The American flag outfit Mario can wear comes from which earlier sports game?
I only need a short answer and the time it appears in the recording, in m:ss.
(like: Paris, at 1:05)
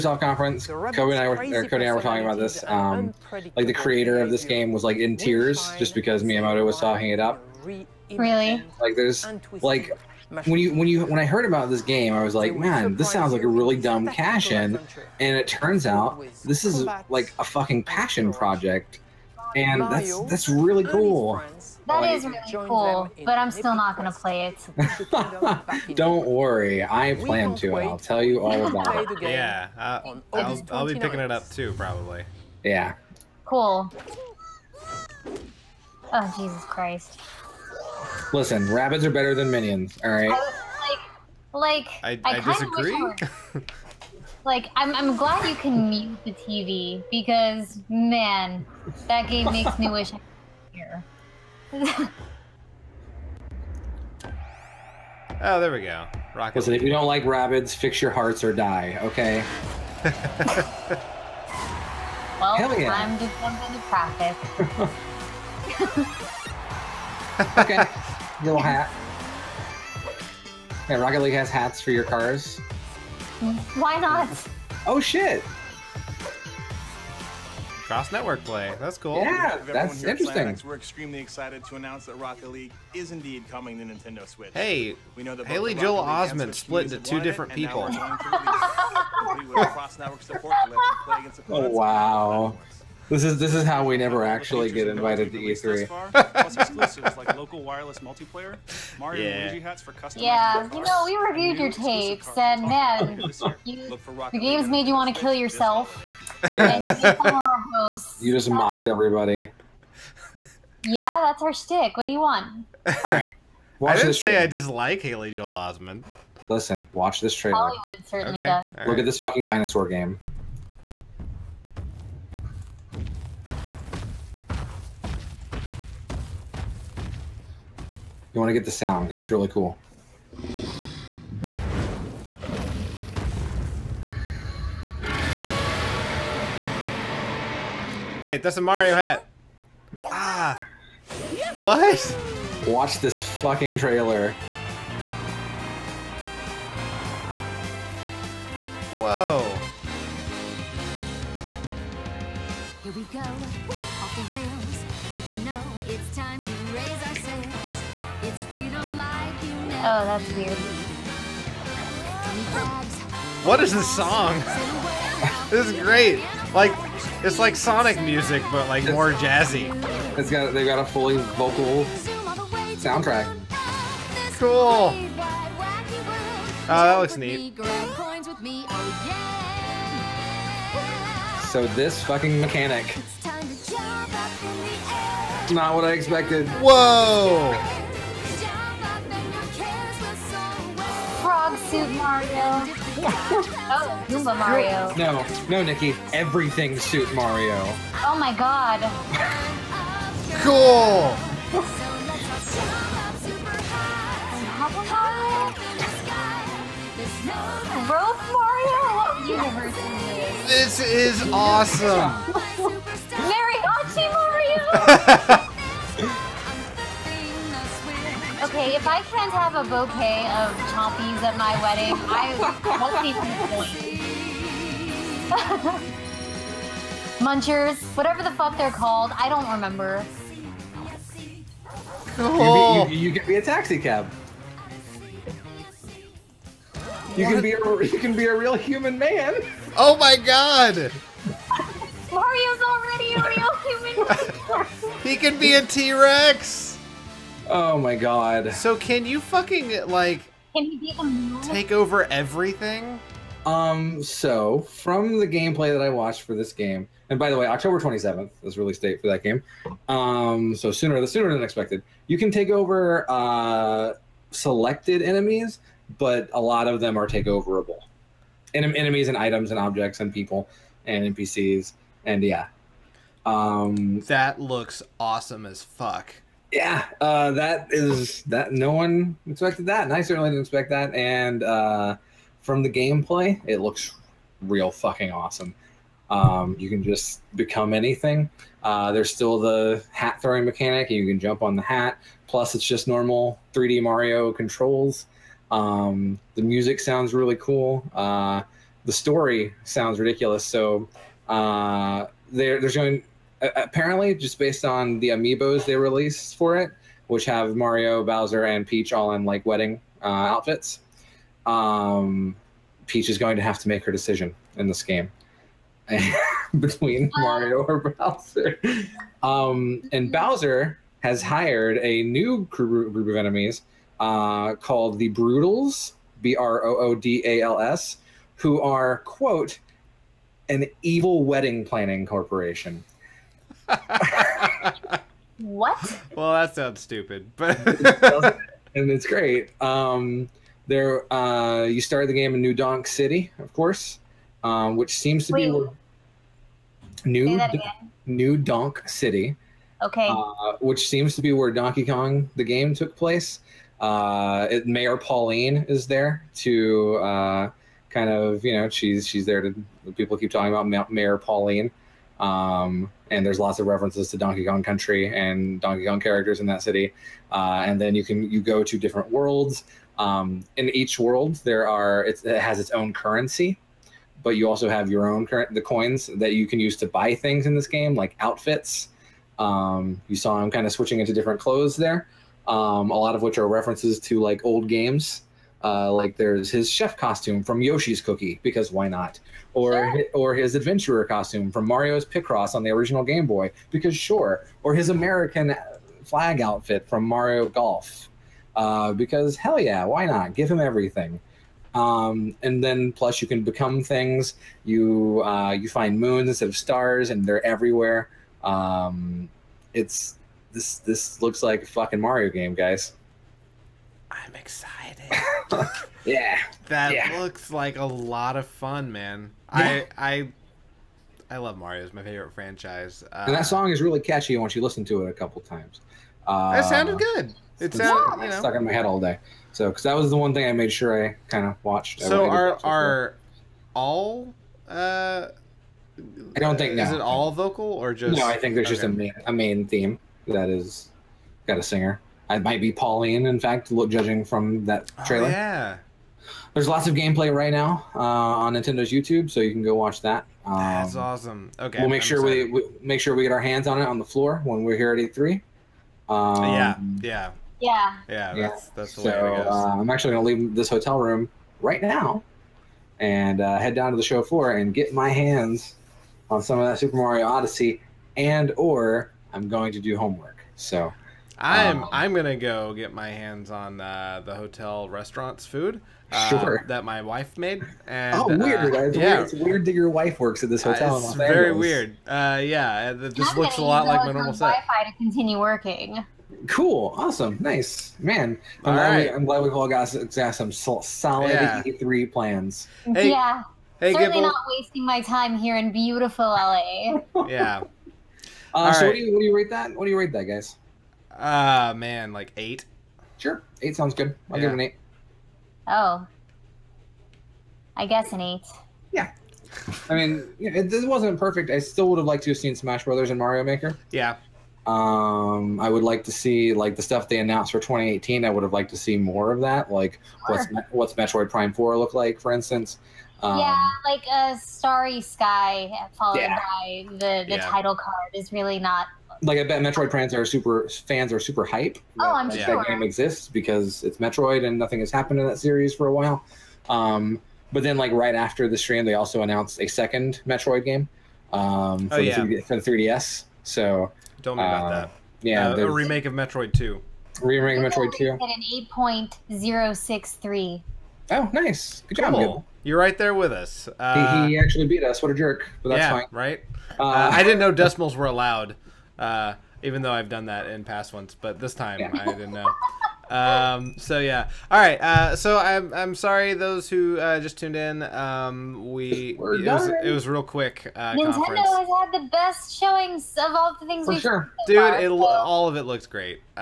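Mario Golf, at 6:37.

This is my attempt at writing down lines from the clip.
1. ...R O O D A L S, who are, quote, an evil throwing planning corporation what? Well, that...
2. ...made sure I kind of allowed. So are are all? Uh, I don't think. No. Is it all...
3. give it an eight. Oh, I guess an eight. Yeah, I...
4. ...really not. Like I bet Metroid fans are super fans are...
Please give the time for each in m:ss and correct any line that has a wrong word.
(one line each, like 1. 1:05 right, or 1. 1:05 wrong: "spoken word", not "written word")
1. 5:26 wrong: "wedding", not "throwing"
2. 7:10 wrong: "watched", not "allowed"
3. 8:24 right
4. 8:48 right.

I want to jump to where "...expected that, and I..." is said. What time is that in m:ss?
4:39.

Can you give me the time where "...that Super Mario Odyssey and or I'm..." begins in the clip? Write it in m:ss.
7:46.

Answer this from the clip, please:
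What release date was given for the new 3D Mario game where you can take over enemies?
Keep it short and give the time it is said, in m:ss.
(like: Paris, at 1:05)
October 27th, at 4:17.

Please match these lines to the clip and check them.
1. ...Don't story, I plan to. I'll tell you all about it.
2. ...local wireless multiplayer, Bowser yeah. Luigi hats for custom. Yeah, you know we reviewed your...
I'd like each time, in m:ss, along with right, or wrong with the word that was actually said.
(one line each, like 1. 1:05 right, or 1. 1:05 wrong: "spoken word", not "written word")
1. 0:25 wrong: "worry", not "story"
2. 1:37 wrong: "Mario", not "Bowser".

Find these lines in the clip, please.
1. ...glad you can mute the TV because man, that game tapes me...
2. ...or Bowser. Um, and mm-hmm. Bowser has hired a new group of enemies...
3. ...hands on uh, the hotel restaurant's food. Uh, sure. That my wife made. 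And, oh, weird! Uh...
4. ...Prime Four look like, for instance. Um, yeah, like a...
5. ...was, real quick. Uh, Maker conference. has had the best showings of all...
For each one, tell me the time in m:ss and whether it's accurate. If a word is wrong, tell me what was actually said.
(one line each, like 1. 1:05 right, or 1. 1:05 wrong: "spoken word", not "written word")
1. 0:45 wrong: "makes", not "tapes"
2. 5:17 right
3. 7:53 right
4. 8:41 right
5. 9:29 wrong: "Nintendo", not "Maker".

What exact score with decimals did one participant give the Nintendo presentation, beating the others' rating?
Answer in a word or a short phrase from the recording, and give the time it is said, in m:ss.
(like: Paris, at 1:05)
8.063, at 9:08.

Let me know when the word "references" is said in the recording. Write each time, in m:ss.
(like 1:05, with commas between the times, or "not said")
6:03, 6:23.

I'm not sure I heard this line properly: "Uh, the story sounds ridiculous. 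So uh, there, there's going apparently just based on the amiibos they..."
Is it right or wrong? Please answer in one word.
right.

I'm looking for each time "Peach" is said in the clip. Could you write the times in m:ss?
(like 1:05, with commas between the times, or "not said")
5:08, 5:12.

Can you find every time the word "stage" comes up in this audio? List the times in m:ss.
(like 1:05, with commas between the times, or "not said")
not said.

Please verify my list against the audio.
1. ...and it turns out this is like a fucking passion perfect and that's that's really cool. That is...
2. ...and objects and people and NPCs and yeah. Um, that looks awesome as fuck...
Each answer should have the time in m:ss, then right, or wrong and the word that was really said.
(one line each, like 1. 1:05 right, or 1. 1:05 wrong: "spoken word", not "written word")
1. 0:15 wrong: "project", not "perfect"
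2. 4:29 right.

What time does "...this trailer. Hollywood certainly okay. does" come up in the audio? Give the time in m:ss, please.
1:57.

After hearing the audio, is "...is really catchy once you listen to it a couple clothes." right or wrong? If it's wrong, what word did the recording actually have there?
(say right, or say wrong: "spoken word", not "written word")
wrong: "times", not "clothes".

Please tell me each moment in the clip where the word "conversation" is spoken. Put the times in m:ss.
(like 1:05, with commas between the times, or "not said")
not said.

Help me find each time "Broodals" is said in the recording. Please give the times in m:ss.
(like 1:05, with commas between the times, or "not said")
5:25.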